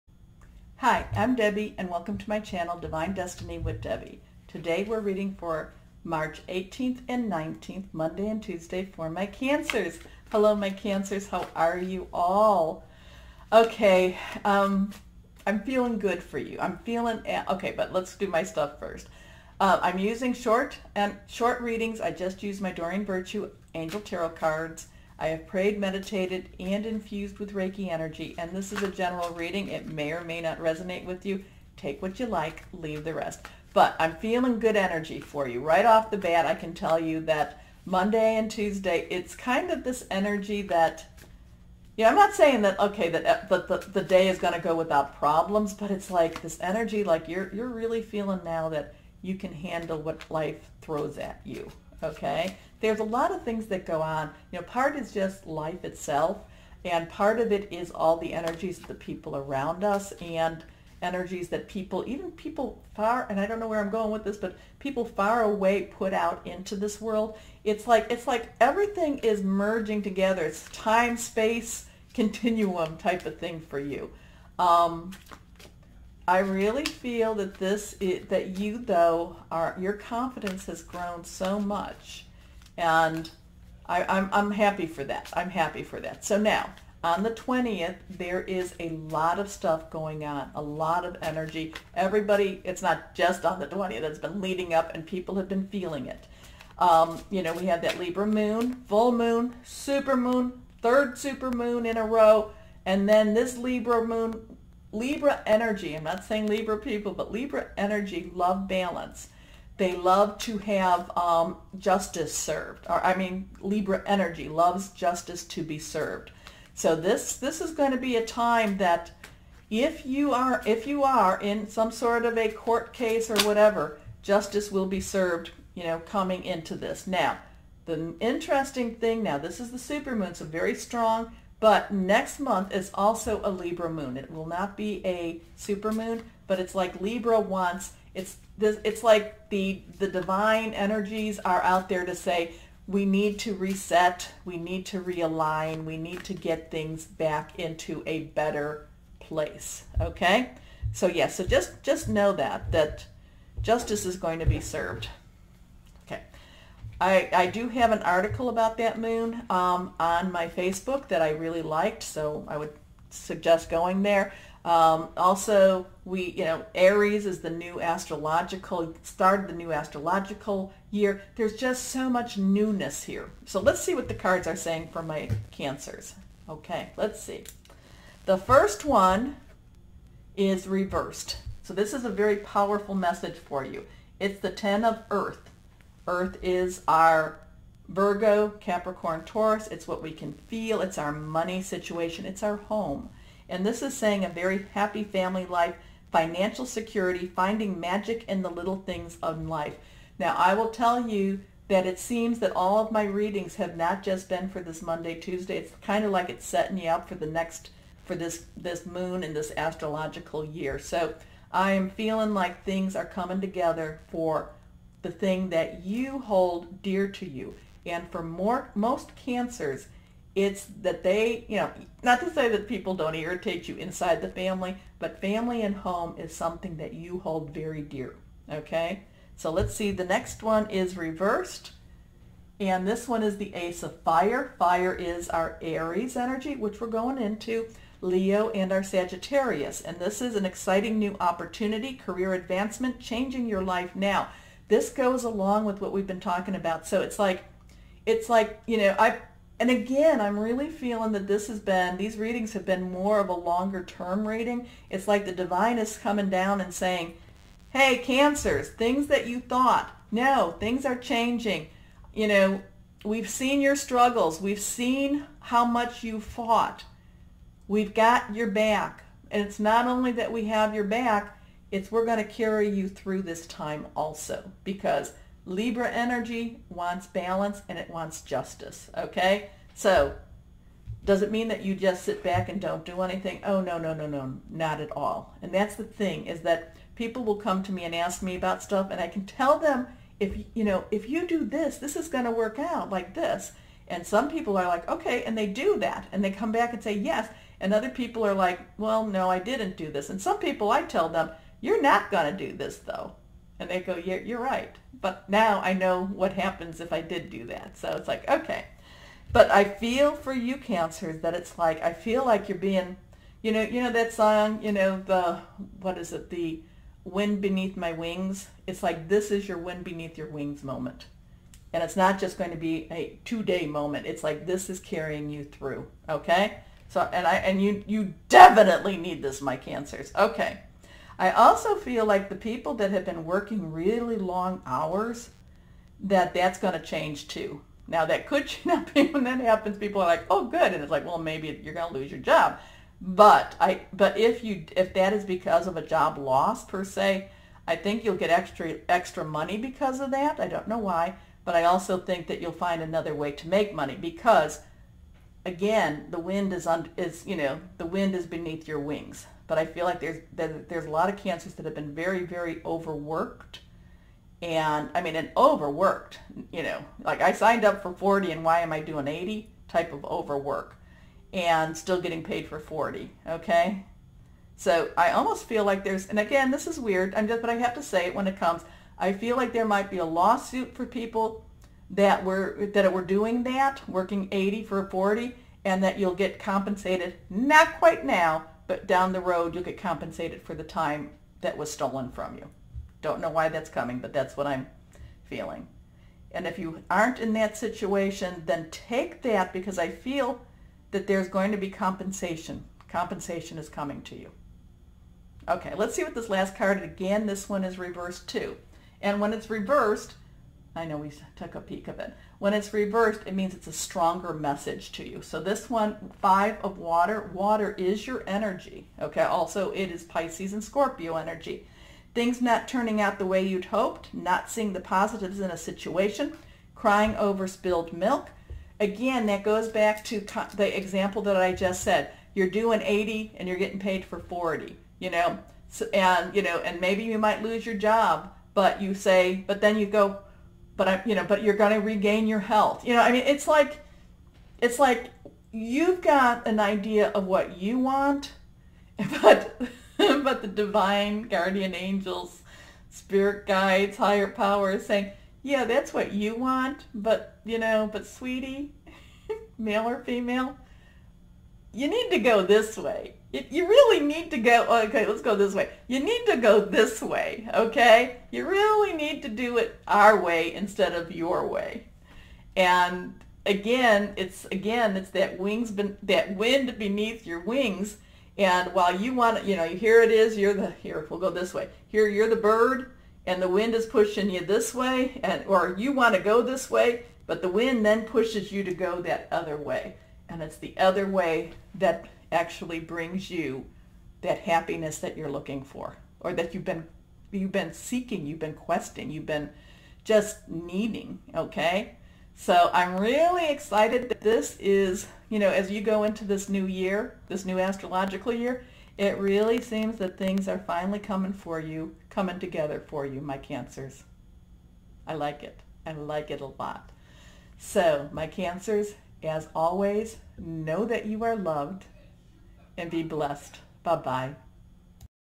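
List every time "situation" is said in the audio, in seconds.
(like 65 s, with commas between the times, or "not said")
191 s, 397 s, 425 s.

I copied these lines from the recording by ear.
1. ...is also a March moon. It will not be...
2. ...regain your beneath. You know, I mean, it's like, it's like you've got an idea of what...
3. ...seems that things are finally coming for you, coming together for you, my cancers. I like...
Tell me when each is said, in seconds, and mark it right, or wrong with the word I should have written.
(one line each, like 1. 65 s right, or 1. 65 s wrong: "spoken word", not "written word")
1. 132 s wrong: "Libra", not "March"
2. 441 s wrong: "health", not "beneath"
3. 509 s right.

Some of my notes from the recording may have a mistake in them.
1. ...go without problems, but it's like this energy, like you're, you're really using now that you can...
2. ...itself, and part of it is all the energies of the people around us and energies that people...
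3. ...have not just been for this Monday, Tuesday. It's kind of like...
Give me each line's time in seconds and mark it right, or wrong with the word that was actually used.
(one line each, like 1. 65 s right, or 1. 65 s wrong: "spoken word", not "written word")
1. 44 s wrong: "feeling", not "using"
2. 55 s right
3. 203 s right.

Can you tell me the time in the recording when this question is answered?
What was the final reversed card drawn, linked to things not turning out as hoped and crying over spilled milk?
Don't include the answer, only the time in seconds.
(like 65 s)
416 s.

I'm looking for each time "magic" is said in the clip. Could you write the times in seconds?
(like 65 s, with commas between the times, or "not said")
197 s.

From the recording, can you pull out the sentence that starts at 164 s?
Um, also, we, you know, Aries is the new astrological, started the new astrological year.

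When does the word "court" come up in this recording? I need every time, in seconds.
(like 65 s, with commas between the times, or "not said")
122 s.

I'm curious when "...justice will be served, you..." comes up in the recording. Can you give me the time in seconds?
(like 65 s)
124 s.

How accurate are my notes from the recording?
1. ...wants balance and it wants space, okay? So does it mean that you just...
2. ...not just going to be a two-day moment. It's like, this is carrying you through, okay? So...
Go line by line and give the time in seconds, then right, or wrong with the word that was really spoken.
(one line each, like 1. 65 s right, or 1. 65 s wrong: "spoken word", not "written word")
1. 276 s wrong: "justice", not "space"
2. 321 s right.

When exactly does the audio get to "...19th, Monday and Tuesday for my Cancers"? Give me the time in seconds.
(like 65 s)
7 s.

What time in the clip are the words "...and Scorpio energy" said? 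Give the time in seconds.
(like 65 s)
420 s.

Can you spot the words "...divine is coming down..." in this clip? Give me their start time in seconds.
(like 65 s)
255 s.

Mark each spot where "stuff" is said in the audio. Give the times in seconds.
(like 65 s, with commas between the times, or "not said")
18 s, 89 s, 288 s.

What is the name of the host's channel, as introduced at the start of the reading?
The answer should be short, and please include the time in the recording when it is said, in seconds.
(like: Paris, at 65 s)
Divine Destiny with Debbie, at 2 s.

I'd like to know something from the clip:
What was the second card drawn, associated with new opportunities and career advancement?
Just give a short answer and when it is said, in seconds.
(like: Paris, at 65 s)
Ace of Fire, at 233 s.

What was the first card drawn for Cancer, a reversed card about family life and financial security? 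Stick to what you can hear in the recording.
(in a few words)
10 of Earth.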